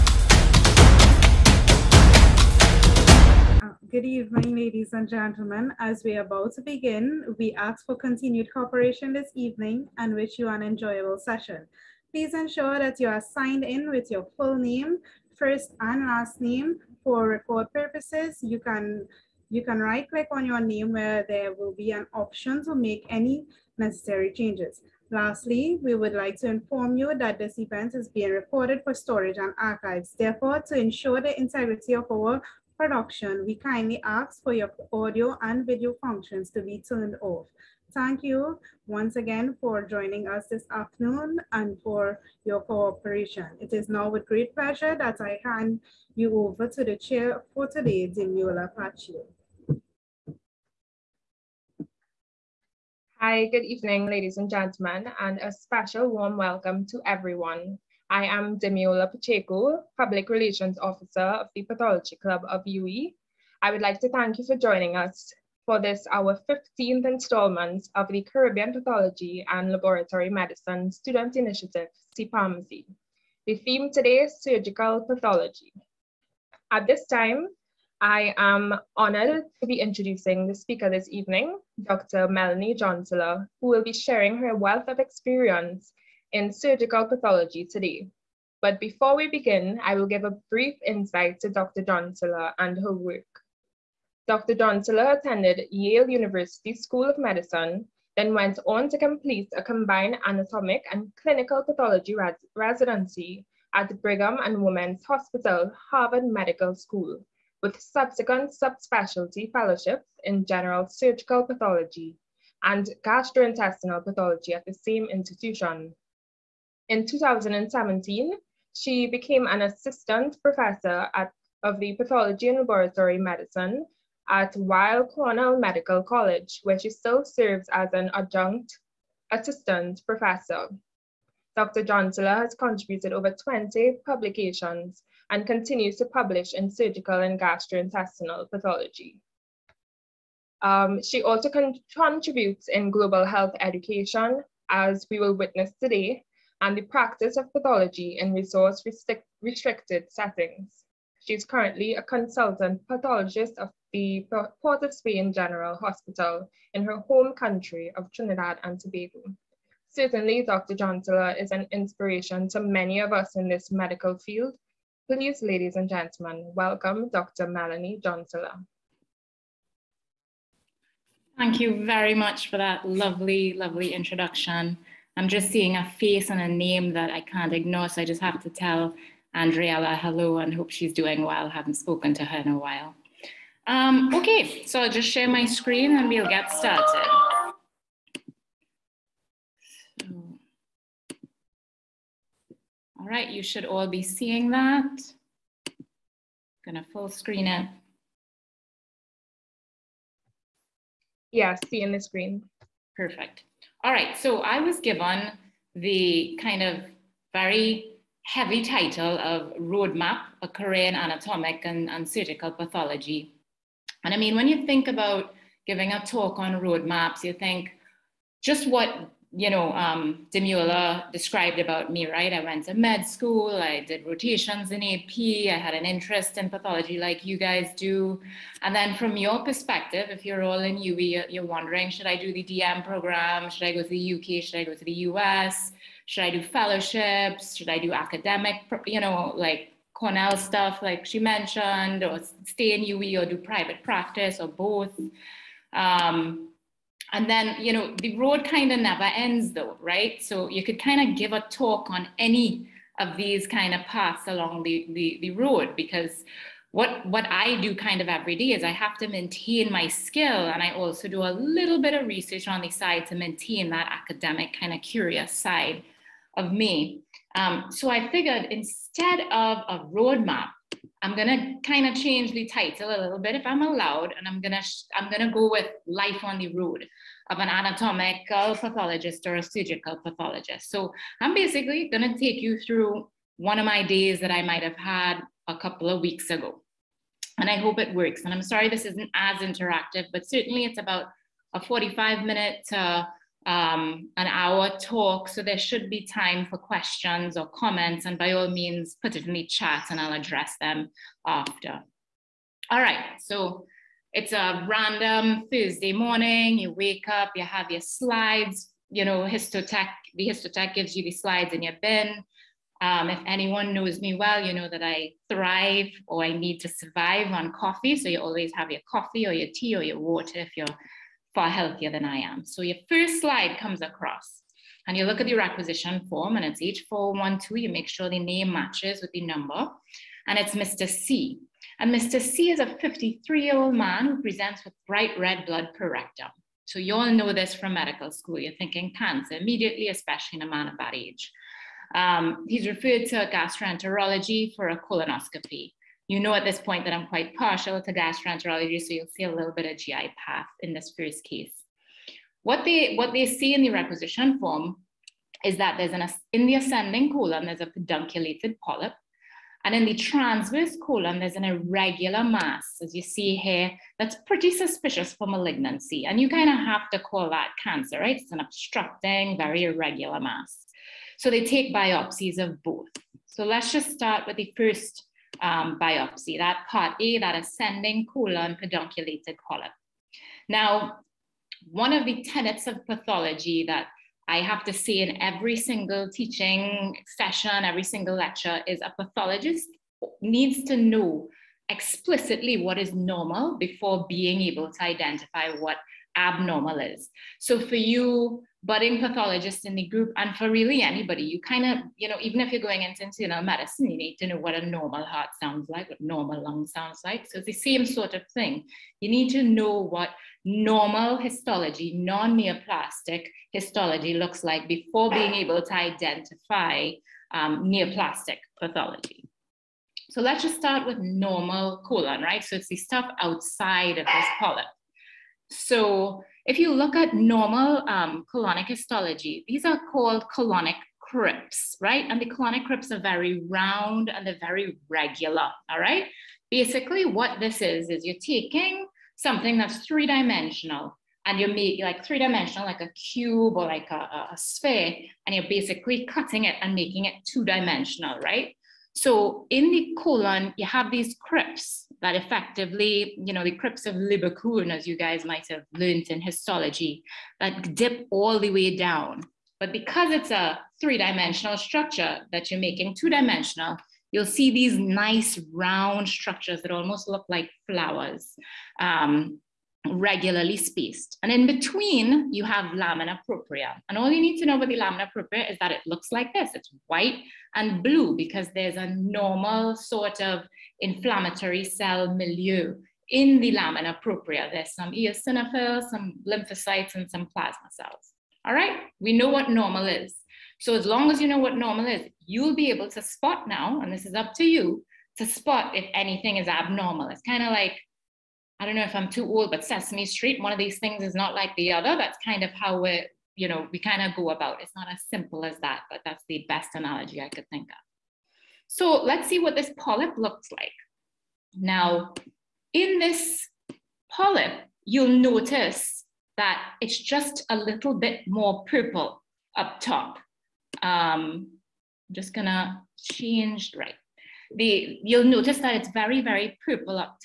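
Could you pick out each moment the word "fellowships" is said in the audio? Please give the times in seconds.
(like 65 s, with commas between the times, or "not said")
109 s, 236 s.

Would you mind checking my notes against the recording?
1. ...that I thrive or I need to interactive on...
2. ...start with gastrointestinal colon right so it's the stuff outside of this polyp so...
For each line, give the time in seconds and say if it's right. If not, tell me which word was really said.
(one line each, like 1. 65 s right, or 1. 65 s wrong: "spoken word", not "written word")
1. 314 s wrong: "survive", not "interactive"
2. 420 s wrong: "normal", not "gastrointestinal".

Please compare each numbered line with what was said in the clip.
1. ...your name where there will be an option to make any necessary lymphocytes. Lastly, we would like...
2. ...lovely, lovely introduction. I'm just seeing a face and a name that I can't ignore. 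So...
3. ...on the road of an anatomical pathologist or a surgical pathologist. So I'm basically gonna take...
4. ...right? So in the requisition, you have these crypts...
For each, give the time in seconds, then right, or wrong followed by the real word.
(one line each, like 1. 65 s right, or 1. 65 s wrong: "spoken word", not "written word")
1. 20 s wrong: "changes", not "lymphocytes"
2. 172 s right
3. 276 s right
4. 448 s wrong: "colon", not "requisition".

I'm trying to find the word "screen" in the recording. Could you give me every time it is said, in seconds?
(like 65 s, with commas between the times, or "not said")
185 s, 197 s, 201 s.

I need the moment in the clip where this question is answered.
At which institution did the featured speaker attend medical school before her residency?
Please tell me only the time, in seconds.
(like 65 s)
95 s.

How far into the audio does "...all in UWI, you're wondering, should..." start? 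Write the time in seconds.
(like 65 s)
230 s.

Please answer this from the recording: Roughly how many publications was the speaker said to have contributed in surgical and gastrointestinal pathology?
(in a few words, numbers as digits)
Over 20.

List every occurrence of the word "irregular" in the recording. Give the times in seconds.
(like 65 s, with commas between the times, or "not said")
361 s, 369 s.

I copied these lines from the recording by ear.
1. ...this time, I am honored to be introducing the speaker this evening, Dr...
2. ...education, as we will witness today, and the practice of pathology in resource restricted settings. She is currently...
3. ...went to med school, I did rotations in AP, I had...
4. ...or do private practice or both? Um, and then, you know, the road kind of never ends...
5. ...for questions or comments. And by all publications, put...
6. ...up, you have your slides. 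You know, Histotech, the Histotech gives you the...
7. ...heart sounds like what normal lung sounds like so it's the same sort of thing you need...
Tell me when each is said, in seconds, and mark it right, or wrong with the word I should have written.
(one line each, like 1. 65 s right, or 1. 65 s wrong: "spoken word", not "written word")
1. 76 s right
2. 143 s right
3. 222 s right
4. 243 s right
5. 296 s wrong: "means", not "publications"
6. 307 s right
7. 405 s right.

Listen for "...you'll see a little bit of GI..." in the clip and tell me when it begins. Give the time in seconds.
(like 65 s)
348 s.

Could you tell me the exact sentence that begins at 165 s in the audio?
Please, ladies and gentlemen, welcome Dr.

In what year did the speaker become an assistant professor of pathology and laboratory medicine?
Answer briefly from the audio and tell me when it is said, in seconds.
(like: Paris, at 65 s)
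2017, at 117 s.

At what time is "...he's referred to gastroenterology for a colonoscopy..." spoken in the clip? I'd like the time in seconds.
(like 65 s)
342 s.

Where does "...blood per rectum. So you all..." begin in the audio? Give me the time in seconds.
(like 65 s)
335 s.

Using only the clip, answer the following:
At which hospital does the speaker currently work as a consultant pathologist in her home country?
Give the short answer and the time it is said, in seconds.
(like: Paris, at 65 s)
Port of Spain General Hospital, at 154 s.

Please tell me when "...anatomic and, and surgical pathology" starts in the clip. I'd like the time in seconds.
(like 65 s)
210 s.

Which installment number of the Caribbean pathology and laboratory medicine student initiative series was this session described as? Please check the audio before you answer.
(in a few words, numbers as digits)
15th.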